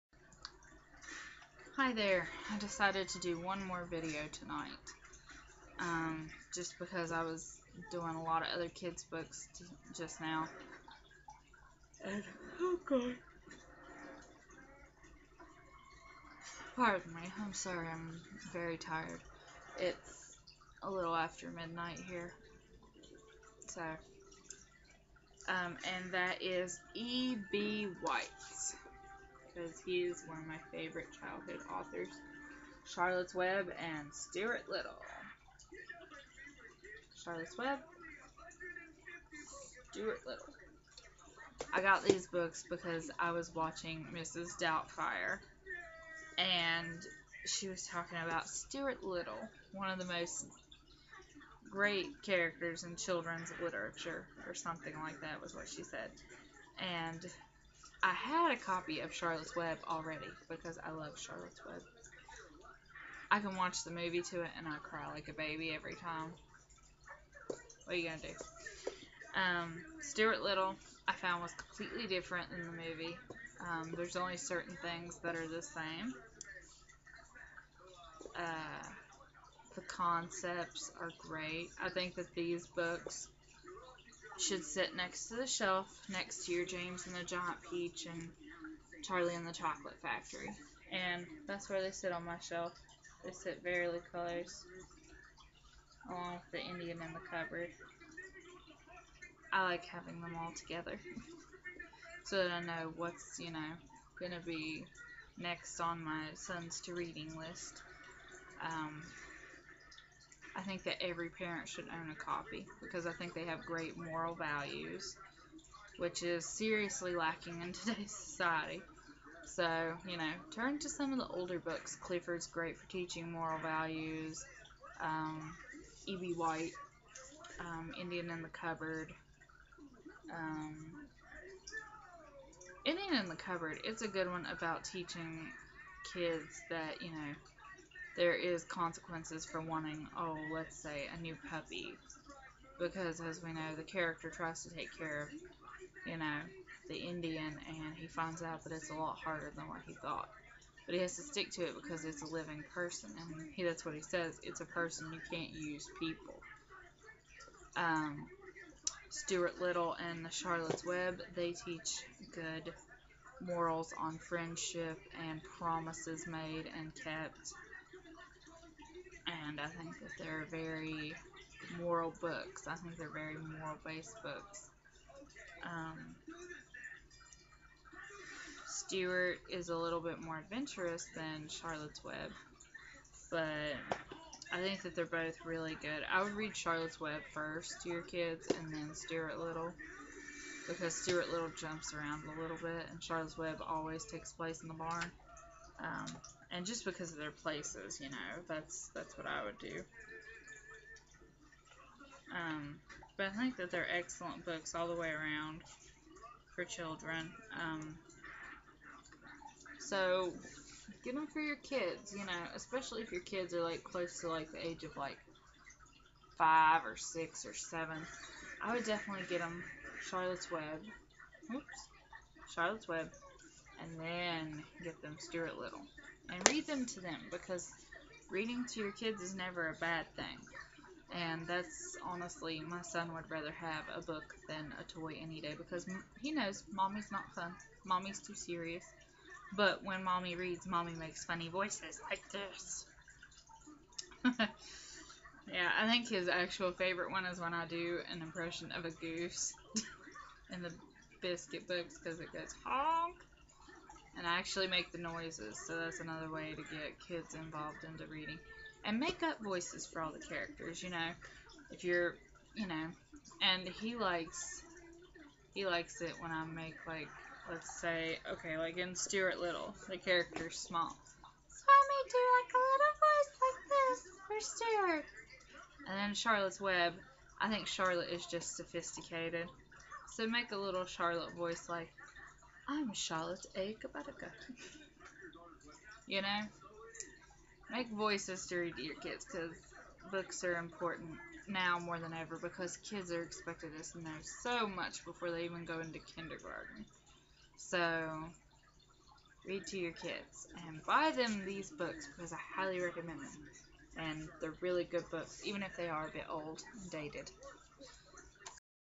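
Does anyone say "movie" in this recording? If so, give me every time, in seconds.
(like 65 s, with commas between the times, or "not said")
63 s, 72 s.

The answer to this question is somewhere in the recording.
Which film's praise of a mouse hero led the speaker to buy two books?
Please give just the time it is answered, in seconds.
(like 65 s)
44 s.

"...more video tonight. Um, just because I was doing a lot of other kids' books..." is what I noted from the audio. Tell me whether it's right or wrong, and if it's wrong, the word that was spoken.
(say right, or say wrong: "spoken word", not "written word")
right.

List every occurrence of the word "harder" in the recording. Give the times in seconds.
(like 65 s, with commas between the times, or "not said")
149 s.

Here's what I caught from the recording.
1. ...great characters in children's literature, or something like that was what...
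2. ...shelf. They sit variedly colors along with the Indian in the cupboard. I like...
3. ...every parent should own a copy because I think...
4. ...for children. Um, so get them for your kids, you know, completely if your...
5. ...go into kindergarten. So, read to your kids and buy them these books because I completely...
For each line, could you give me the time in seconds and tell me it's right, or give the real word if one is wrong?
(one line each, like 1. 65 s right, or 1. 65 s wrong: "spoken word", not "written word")
1. 51 s right
2. 92 s right
3. 111 s right
4. 206 s wrong: "especially", not "completely"
5. 295 s wrong: "highly", not "completely".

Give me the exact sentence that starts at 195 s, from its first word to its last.
Um, and just because of their places, you know, that's that's what I would do.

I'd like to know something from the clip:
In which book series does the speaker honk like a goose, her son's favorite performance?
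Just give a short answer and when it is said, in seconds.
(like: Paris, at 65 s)
biscuit books, at 251 s.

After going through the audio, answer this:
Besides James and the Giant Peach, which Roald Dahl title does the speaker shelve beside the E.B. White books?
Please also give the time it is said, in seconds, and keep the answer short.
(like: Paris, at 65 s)
Charlie and the Chocolate Factory, at 89 s.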